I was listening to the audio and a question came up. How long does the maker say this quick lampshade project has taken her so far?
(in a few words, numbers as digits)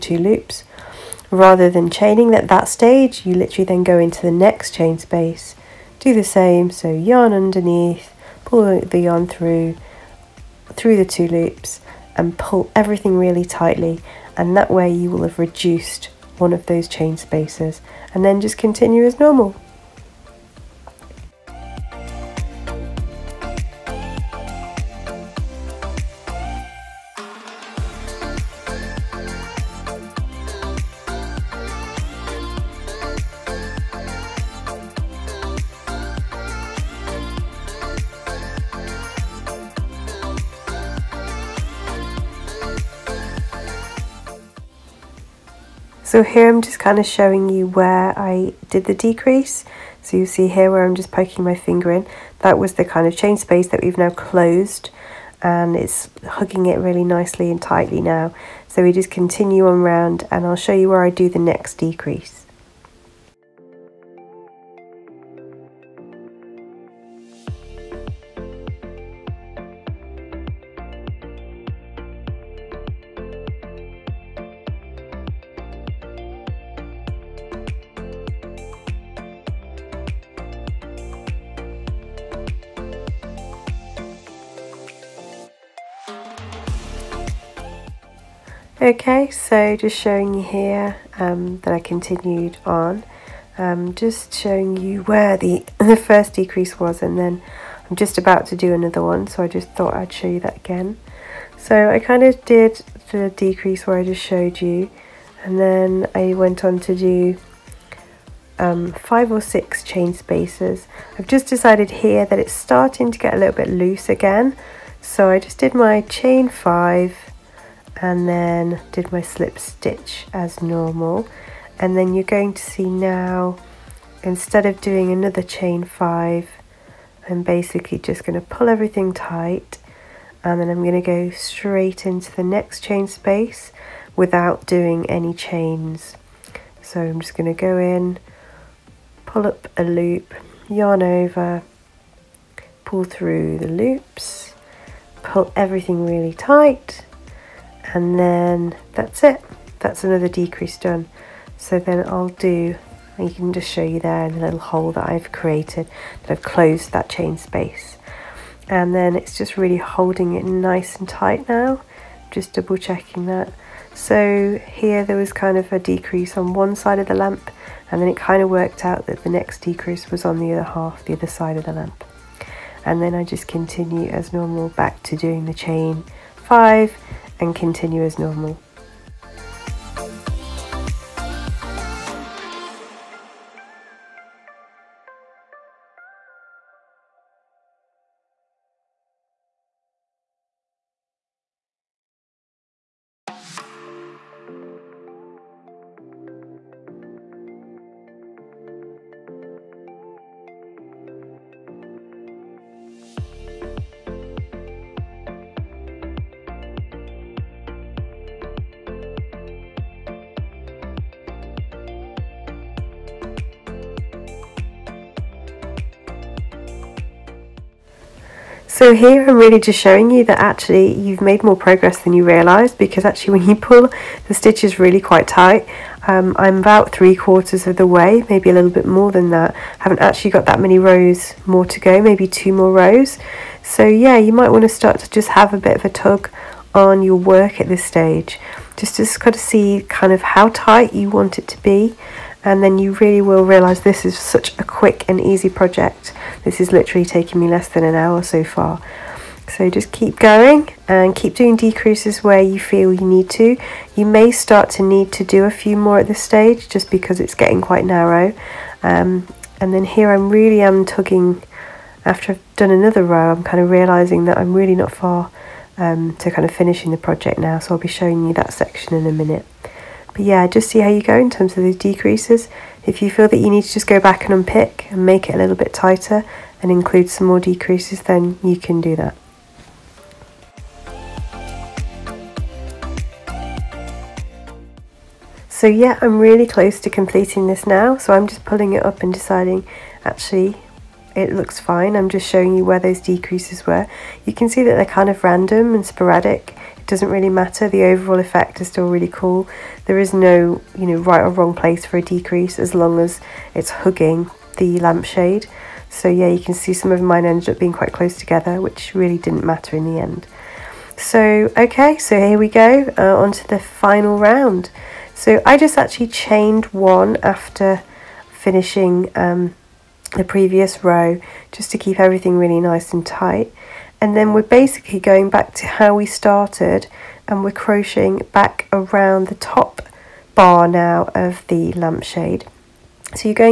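less than an hour.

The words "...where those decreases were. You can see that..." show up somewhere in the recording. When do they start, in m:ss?
4:52.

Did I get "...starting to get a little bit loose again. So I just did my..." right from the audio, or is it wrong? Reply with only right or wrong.
right.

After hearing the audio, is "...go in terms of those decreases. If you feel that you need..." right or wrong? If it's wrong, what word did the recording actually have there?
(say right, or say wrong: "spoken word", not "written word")
right.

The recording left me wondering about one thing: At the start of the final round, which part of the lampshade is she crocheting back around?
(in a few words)
top bar.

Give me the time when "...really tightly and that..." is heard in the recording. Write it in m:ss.
0:13.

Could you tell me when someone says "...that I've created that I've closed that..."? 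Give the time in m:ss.
2:34.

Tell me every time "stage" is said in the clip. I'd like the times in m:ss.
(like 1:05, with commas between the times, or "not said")
0:02, 3:57, 4:16.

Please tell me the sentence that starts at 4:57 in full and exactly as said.
The overall effect is still really cool.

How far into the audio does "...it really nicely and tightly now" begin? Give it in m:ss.
0:56.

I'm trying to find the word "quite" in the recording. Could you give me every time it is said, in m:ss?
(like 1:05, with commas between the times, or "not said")
3:44, 4:17, 5:07.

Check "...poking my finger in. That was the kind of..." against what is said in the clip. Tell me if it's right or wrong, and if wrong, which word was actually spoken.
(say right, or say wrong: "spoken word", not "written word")
right.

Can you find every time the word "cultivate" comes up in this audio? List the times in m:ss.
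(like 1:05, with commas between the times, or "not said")
not said.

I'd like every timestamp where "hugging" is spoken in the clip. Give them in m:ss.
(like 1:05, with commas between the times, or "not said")
0:56, 5:03.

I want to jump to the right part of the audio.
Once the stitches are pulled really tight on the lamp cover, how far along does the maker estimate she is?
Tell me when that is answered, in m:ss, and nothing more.
3:46.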